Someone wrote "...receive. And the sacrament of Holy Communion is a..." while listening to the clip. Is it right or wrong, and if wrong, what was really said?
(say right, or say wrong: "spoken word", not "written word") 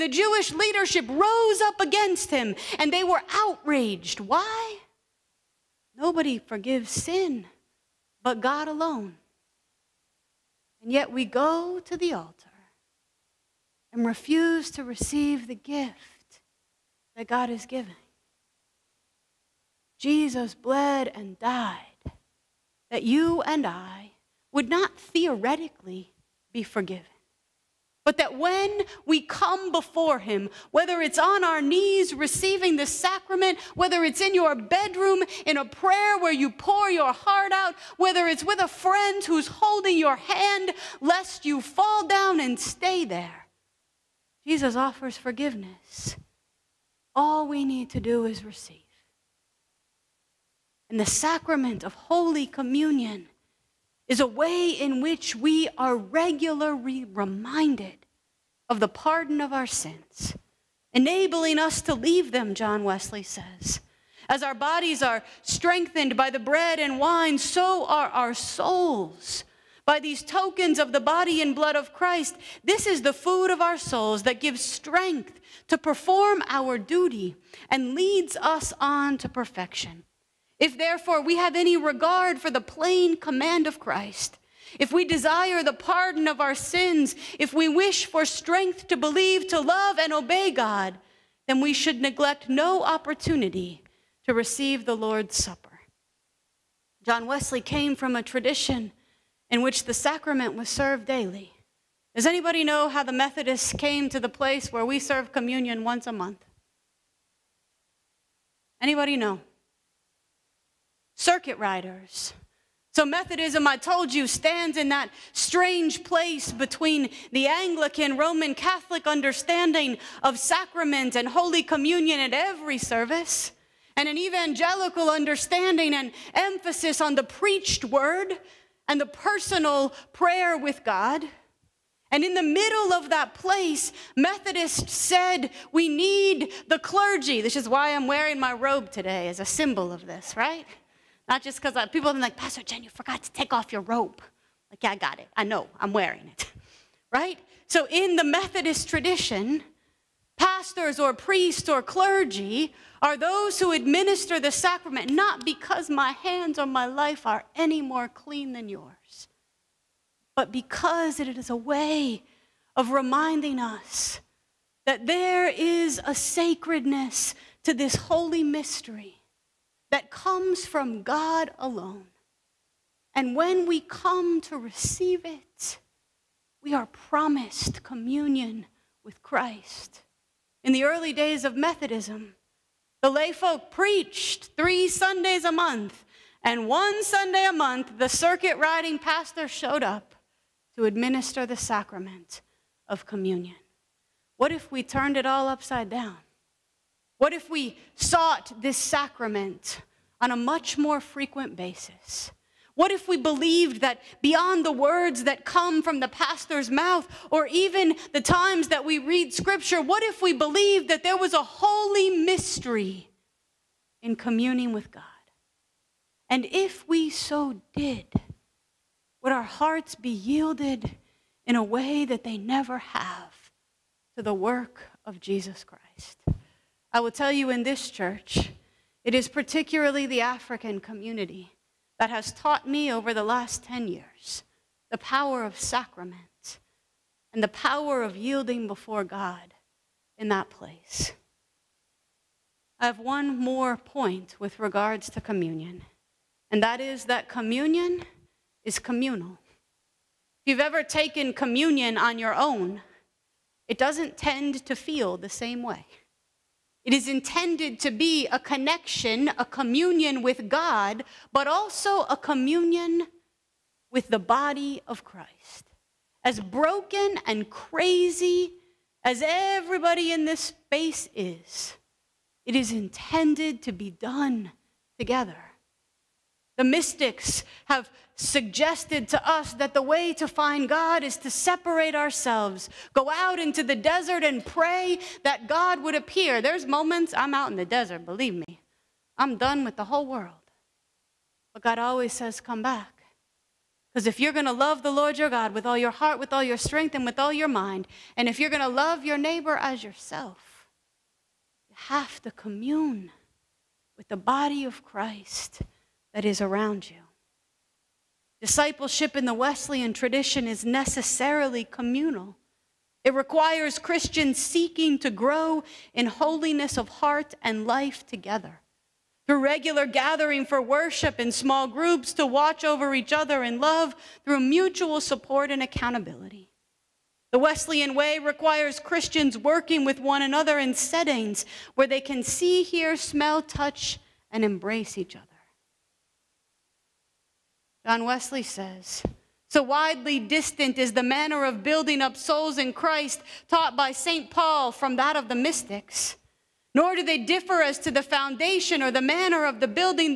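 right.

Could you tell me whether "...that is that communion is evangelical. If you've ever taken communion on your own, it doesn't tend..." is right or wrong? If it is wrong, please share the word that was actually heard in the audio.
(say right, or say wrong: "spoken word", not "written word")
wrong: "communal", not "evangelical".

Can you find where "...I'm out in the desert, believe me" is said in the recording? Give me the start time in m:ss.
4:47.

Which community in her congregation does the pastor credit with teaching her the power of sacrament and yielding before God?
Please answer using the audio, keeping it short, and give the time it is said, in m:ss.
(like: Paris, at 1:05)
The African community, at 3:50.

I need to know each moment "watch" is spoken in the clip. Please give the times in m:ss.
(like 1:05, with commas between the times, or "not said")
5:22.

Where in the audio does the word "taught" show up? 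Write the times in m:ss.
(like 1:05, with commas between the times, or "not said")
3:52, 5:43.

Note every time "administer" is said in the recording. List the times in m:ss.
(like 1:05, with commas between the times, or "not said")
2:33, 3:10.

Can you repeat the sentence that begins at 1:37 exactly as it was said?
John Wesley came from a tradition in which the sacrament was served daily.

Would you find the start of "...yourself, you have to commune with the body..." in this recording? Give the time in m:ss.
4:59.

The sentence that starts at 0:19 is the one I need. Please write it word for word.
Jesus bled and died that you and I would not theoretically be forgiven.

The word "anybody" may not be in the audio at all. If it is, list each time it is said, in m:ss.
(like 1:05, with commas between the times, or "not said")
1:42, 1:48.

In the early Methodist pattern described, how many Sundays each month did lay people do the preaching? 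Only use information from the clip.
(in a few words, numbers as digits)
3.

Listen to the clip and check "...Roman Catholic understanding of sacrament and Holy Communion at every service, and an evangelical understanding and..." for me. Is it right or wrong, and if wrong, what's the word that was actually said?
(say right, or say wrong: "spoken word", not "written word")
right.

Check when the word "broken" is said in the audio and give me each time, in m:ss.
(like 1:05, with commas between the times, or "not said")
4:26.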